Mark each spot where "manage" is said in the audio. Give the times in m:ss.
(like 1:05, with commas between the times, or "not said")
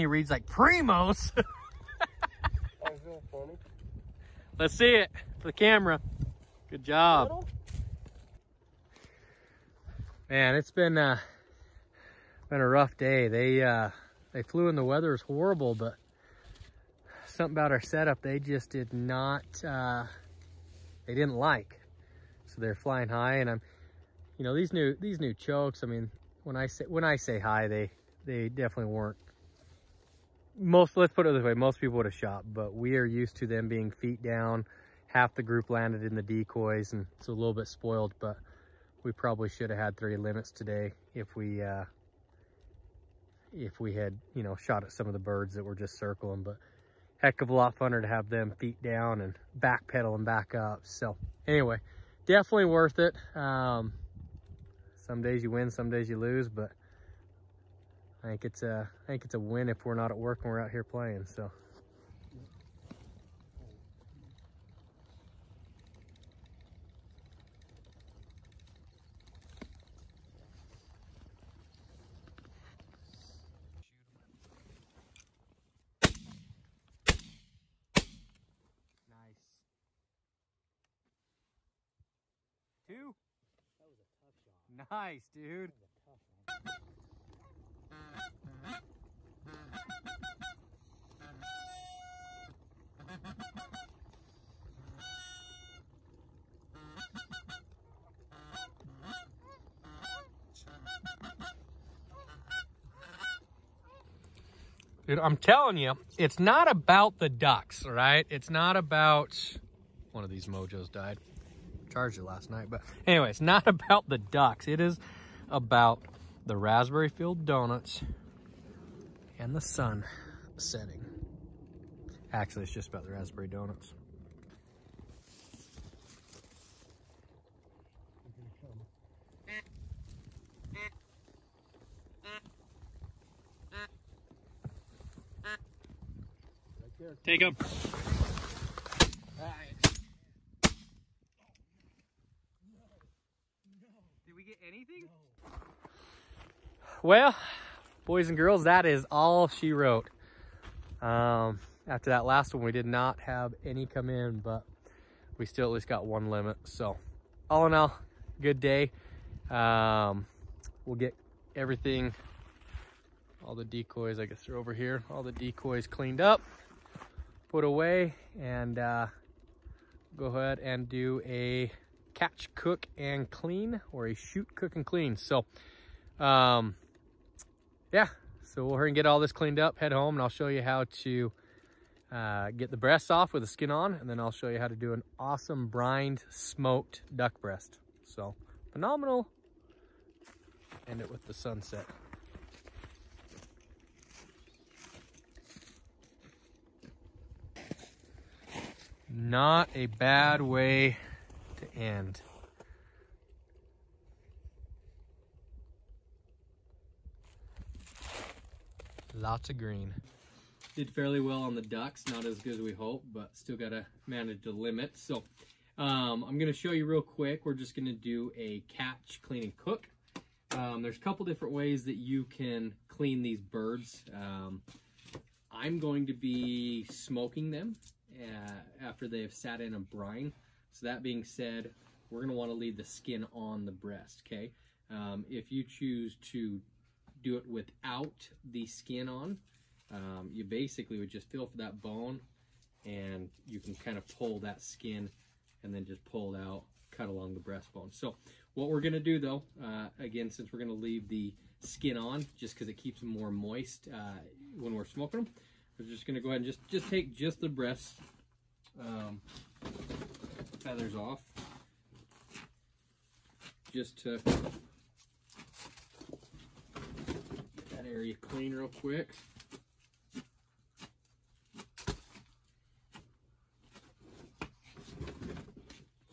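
3:34.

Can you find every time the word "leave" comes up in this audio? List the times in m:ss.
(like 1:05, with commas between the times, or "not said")
3:52, 4:10.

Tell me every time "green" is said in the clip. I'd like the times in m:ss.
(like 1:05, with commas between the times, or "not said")
3:29.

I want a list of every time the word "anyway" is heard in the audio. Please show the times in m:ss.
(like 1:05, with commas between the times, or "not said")
0:51, 1:53.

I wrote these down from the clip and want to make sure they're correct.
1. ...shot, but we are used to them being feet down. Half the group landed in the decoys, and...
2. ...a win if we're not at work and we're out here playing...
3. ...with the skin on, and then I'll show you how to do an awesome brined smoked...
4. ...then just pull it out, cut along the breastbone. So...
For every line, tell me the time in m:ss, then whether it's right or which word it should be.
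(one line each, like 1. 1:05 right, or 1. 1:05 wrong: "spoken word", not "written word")
1. 0:32 right
2. 0:59 right
3. 3:03 right
4. 4:05 right.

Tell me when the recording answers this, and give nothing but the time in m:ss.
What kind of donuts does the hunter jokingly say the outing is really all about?
2:03.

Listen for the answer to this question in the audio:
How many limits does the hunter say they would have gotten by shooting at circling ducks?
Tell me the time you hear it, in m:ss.
0:39.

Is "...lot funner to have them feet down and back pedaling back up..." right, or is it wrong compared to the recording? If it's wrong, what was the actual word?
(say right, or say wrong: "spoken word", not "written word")
right.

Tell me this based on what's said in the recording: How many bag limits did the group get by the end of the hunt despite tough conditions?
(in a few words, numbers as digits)
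1.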